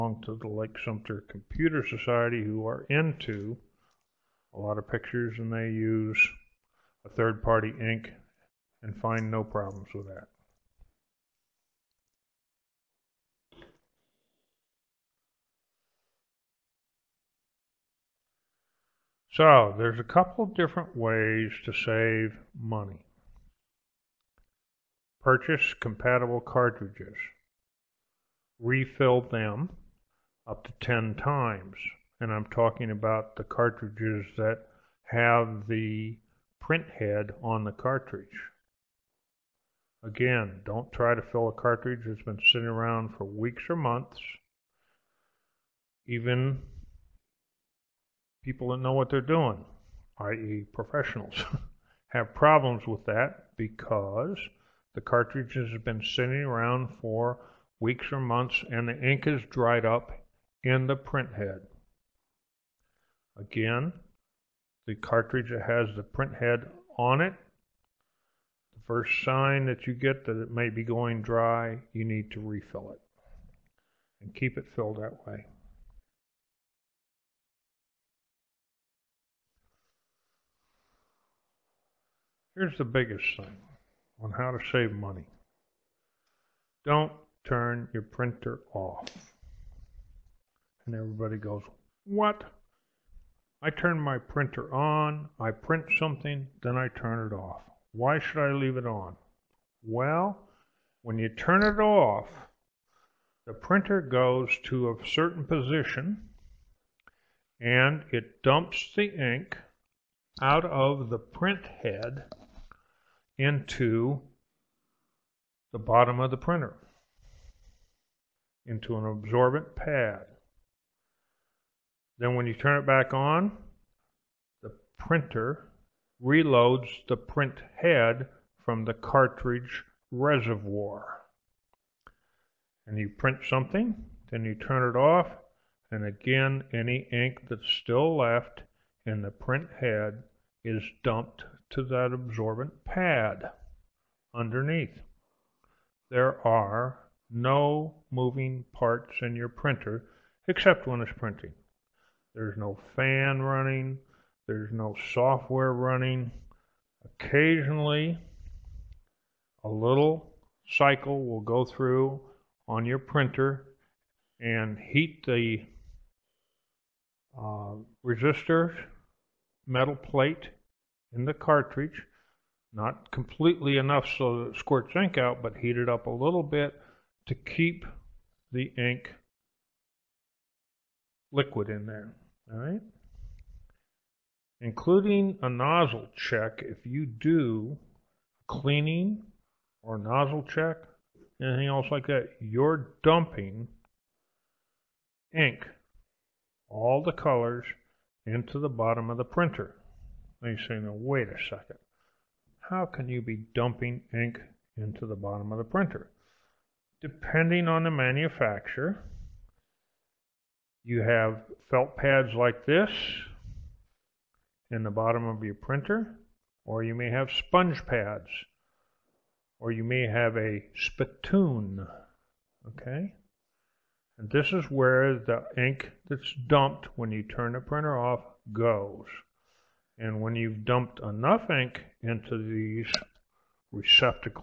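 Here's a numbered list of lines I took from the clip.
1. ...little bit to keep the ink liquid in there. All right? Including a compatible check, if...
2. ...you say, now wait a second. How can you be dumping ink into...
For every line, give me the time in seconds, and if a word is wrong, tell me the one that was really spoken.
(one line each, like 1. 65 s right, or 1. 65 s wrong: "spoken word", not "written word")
1. 176 s wrong: "nozzle", not "compatible"
2. 200 s right.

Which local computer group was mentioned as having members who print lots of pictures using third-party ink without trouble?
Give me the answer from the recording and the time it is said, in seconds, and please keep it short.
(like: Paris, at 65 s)
Lake Sumter Computer Society, at 0 s.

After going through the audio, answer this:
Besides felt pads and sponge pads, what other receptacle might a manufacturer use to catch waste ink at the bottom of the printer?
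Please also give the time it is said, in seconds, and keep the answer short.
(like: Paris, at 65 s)
a spittoon, at 220 s.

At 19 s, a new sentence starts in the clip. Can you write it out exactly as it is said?
So there's a couple different ways to save money.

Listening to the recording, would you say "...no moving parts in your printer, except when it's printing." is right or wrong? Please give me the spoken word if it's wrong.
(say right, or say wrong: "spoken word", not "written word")
right.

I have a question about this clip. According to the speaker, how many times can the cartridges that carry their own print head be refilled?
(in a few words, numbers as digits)
10.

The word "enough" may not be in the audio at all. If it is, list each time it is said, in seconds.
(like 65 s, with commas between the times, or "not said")
173 s, 231 s.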